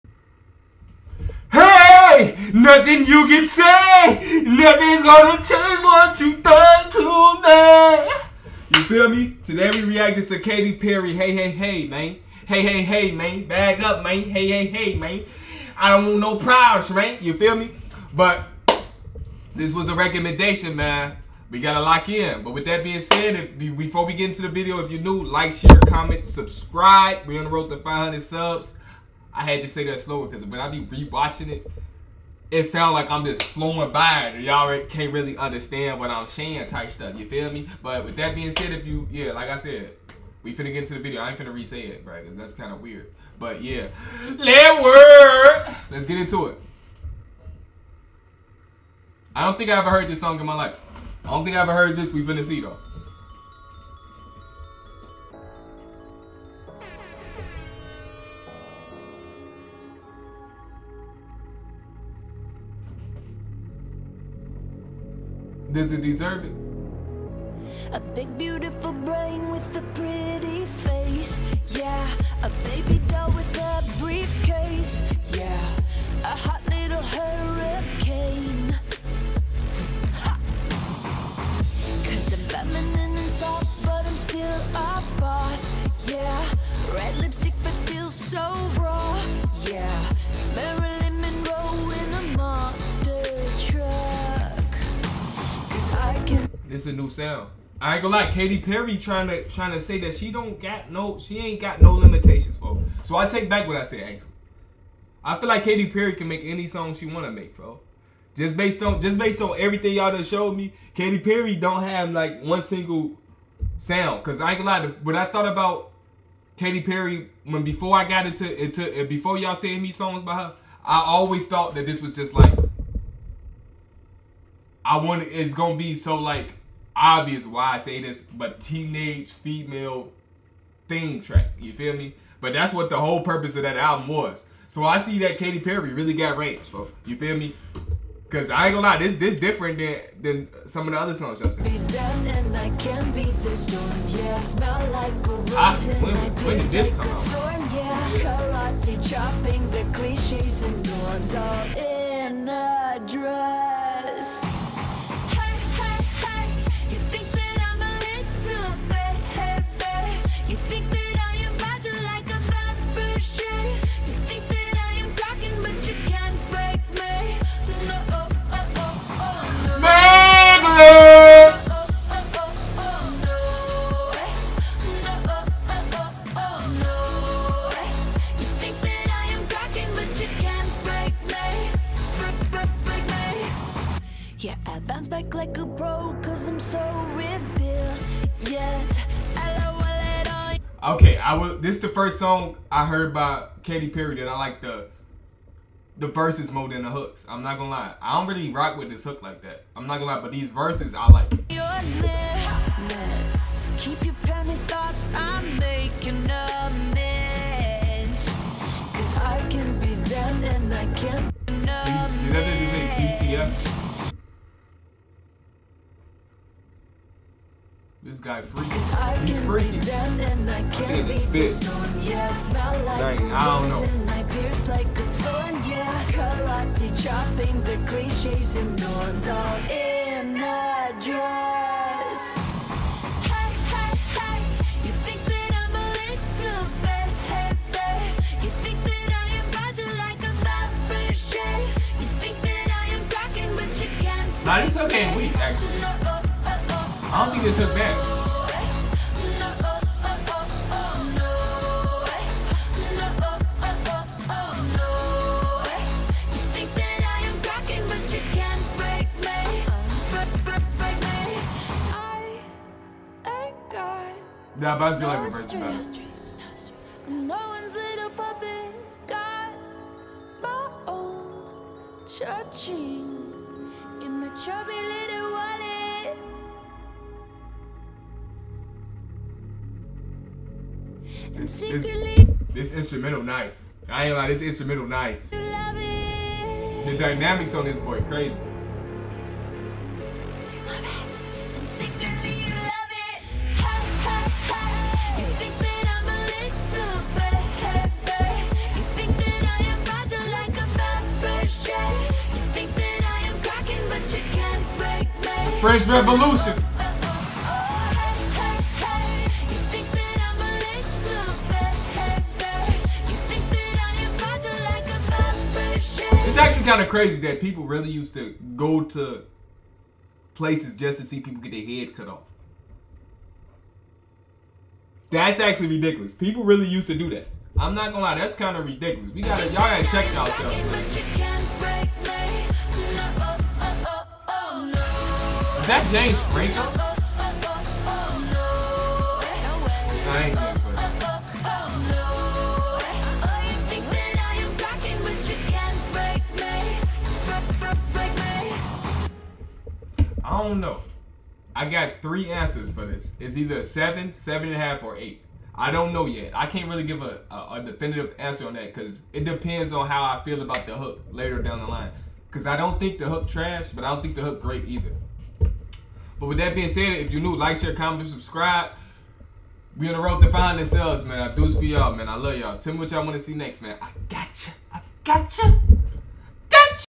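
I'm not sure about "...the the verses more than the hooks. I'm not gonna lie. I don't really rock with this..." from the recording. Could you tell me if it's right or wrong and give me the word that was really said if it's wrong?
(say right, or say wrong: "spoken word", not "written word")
right.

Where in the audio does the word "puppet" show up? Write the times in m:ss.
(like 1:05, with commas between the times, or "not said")
4:28.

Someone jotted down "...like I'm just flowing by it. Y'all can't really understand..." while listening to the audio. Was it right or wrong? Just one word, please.
right.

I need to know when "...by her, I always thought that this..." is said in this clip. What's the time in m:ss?
2:00.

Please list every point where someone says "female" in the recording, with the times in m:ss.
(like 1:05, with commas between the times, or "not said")
2:09.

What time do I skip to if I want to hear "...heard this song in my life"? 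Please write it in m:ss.
0:49.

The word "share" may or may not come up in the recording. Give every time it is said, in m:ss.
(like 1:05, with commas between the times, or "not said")
0:25, 6:07.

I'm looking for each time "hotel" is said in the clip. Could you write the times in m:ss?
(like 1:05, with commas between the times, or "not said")
not said.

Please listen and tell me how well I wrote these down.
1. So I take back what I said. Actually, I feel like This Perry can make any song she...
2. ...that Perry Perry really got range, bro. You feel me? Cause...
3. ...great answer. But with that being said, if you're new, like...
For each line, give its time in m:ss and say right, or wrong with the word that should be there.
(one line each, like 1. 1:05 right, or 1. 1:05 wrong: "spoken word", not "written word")
1. 1:43 wrong: "Katy", not "This"
2. 2:15 wrong: "Katy", not "Perry"
3. 6:04 wrong: "either", not "answer".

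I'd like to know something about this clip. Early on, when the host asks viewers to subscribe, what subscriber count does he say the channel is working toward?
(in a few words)
500.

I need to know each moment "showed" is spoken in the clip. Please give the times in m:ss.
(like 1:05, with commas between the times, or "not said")
1:50.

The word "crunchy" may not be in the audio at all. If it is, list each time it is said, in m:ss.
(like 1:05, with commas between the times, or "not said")
not said.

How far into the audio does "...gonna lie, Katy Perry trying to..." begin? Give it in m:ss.
1:38.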